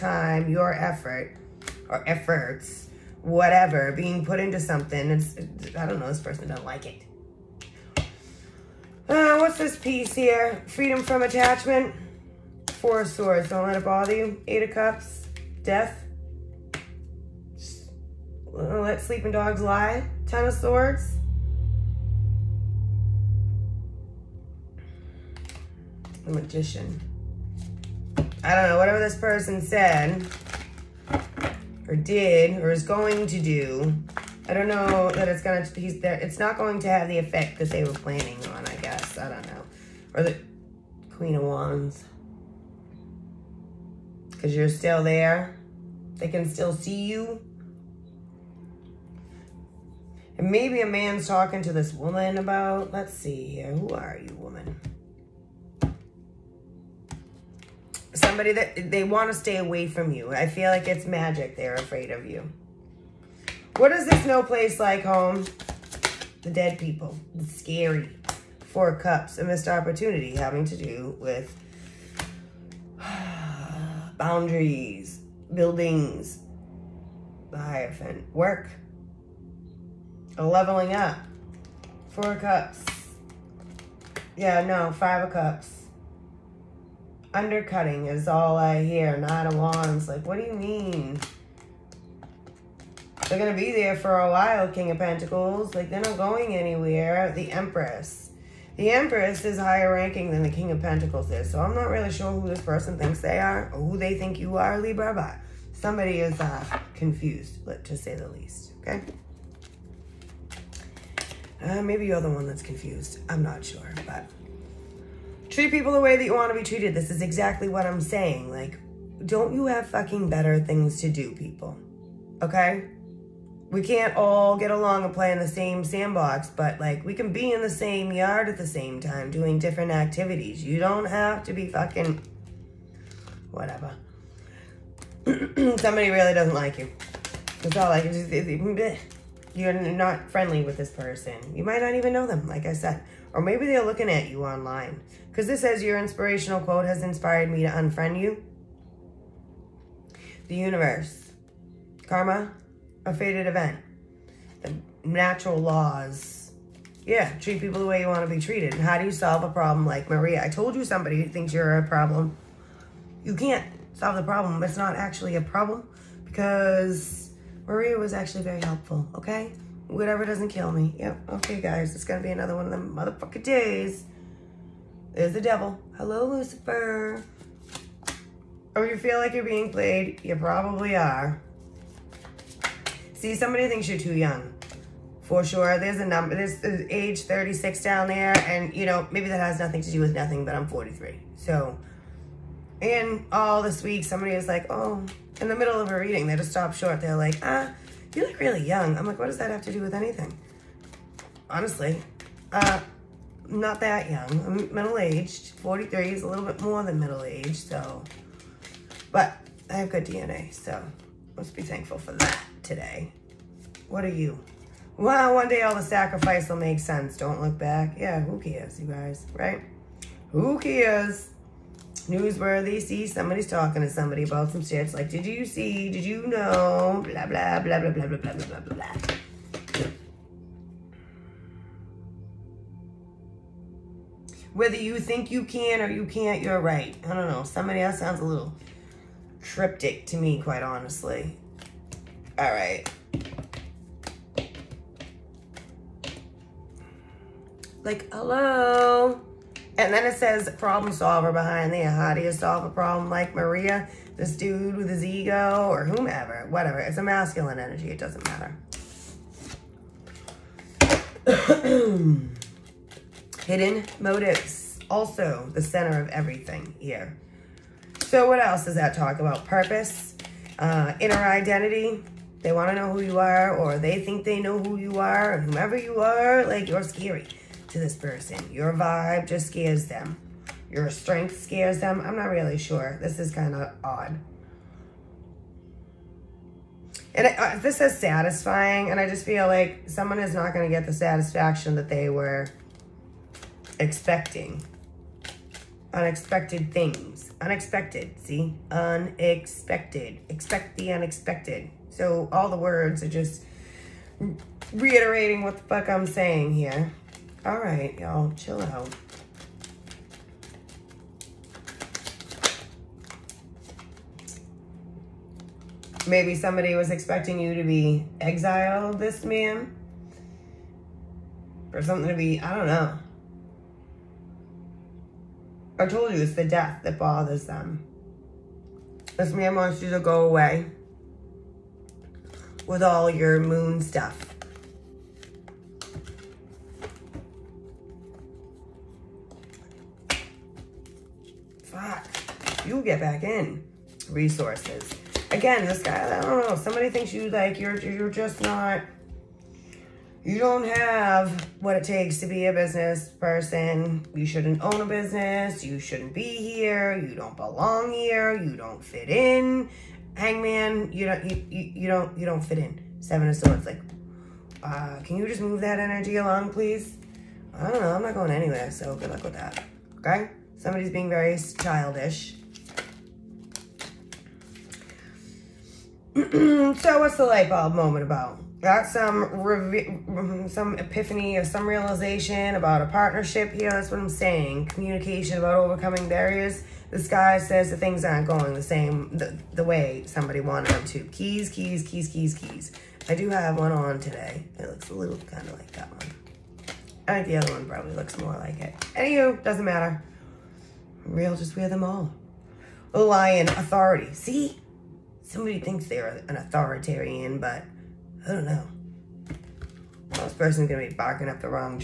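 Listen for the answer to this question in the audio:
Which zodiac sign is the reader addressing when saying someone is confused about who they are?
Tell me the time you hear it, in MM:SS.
01:44.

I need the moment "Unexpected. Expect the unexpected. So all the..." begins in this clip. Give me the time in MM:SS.
04:58.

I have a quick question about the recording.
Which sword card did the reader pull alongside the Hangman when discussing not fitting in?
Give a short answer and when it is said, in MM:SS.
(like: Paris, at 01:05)
Seven of Swords, at 06:02.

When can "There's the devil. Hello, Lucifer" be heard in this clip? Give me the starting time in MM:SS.
02:55.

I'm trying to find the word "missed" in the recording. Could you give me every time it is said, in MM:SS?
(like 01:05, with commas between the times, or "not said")
01:09.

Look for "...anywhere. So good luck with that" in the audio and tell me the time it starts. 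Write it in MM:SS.
06:08.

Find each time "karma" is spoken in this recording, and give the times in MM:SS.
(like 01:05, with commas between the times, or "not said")
02:32.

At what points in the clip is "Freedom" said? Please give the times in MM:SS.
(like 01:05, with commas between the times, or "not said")
00:10.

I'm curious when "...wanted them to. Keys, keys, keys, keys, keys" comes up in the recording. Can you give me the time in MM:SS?
06:30.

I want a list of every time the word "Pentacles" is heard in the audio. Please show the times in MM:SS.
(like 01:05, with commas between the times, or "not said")
01:34, 01:40.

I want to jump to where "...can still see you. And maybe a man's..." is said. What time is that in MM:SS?
00:46.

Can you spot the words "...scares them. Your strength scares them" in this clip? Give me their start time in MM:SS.
04:39.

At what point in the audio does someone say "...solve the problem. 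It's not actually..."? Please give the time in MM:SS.
02:43.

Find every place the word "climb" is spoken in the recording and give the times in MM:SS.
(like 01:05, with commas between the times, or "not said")
not said.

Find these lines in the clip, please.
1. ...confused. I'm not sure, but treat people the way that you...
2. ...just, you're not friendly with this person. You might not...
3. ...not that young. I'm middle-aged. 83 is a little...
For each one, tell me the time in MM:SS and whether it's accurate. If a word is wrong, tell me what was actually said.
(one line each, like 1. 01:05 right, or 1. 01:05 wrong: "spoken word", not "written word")
1. 01:52 right
2. 02:18 right
3. 03:23 wrong: "43", not "83".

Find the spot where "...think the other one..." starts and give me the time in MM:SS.
06:37.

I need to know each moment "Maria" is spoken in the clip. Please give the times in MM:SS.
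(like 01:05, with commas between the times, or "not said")
02:40, 02:47, 04:13.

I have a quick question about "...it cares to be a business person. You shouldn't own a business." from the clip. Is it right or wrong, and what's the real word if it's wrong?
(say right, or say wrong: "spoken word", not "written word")
wrong: "takes", not "cares".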